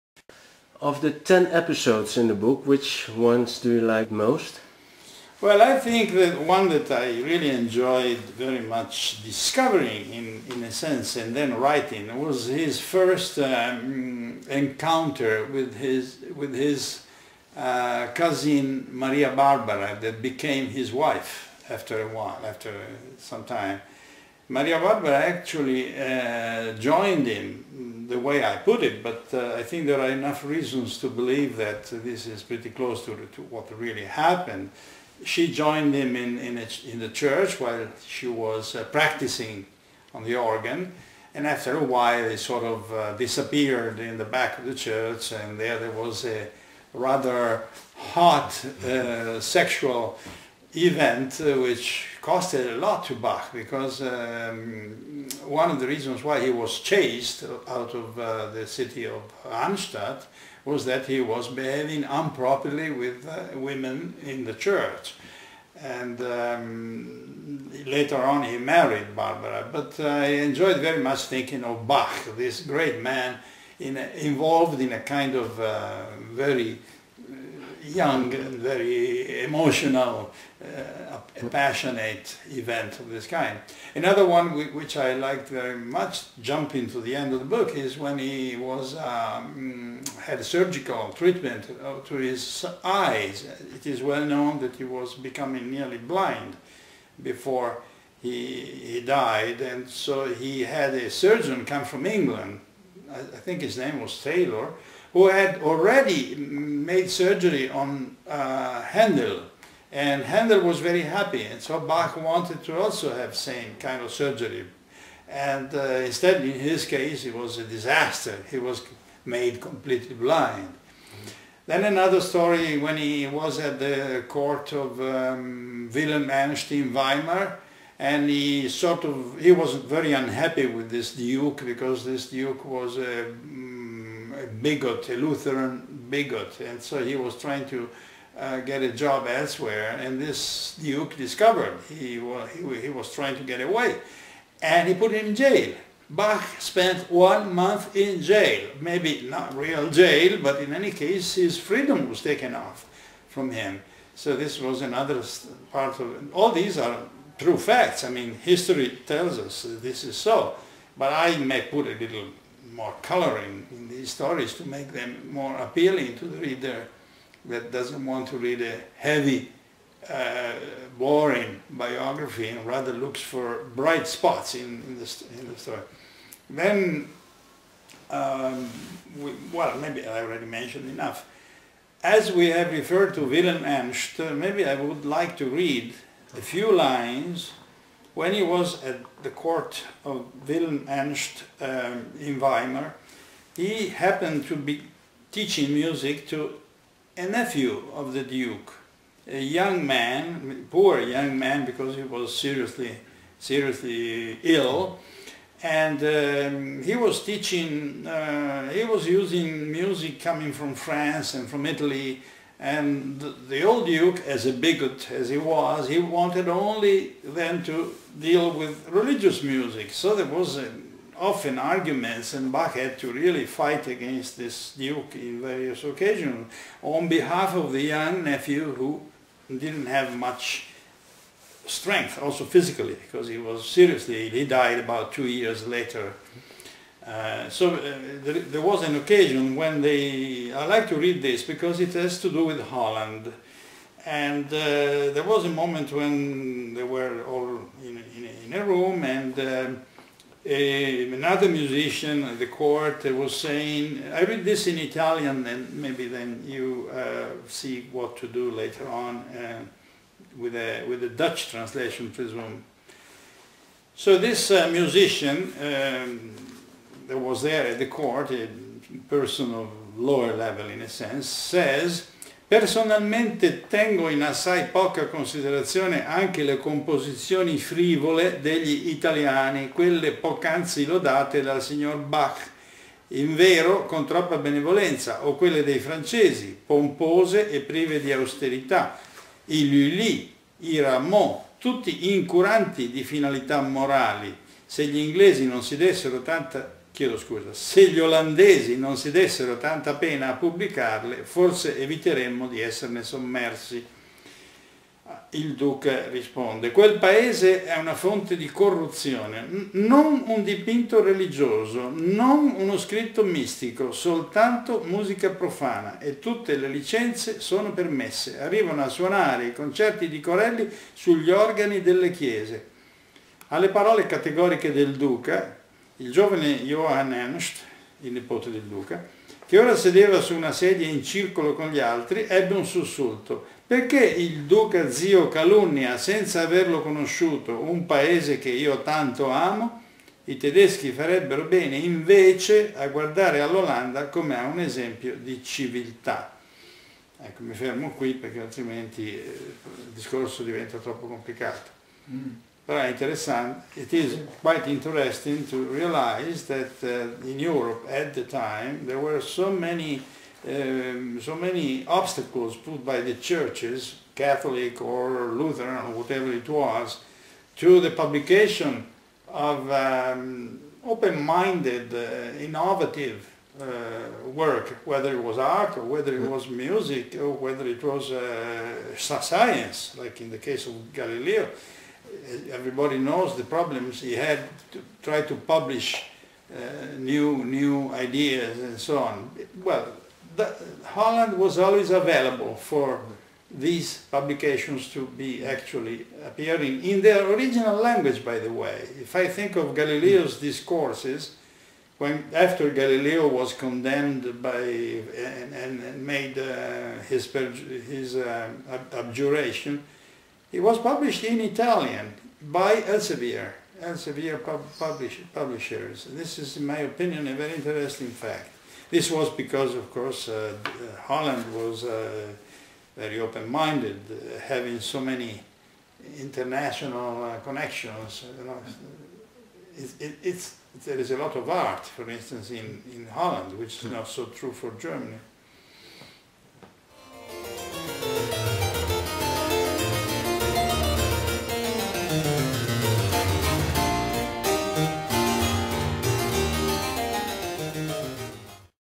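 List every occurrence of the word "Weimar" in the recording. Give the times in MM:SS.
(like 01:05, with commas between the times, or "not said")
02:06, 03:12.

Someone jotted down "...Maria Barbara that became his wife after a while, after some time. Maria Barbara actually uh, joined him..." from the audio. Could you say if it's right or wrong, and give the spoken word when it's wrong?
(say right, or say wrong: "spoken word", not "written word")
right.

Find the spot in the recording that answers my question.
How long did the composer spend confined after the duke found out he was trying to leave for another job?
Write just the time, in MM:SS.
02:27.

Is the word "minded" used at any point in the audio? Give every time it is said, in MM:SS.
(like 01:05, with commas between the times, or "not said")
06:10, 07:03.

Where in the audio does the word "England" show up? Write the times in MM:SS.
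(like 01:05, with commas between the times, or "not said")
01:42.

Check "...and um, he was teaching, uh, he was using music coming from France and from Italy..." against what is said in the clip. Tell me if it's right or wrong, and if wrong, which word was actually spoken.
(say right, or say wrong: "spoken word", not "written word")
right.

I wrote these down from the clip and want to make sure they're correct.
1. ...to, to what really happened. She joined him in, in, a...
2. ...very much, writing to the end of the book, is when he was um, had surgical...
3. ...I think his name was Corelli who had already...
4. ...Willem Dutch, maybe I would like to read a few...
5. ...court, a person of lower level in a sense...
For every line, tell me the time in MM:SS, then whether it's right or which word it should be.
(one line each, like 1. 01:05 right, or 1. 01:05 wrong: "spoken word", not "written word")
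1. 00:33 right
2. 01:25 wrong: "jumping", not "writing"
3. 01:43 wrong: "Taylor", not "Corelli"
4. 03:03 wrong: "Ernst", not "Dutch"
5. 04:27 right.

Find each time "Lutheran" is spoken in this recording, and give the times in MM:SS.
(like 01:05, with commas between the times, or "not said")
02:15, 06:05.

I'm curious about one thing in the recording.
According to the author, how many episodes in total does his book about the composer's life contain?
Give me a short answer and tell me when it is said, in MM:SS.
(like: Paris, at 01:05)
10, at 00:01.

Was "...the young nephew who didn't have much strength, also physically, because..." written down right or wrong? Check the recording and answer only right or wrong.
right.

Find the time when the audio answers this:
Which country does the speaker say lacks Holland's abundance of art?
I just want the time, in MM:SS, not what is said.
07:14.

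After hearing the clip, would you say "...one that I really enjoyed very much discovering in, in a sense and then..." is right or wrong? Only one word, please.
right.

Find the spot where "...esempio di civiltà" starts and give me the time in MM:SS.
05:44.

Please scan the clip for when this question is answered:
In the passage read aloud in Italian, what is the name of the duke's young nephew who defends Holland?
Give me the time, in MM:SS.
05:26.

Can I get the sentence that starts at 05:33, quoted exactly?
Perché il duca zio calunnia, senza averlo conosciuto, un paese che io tanto amo?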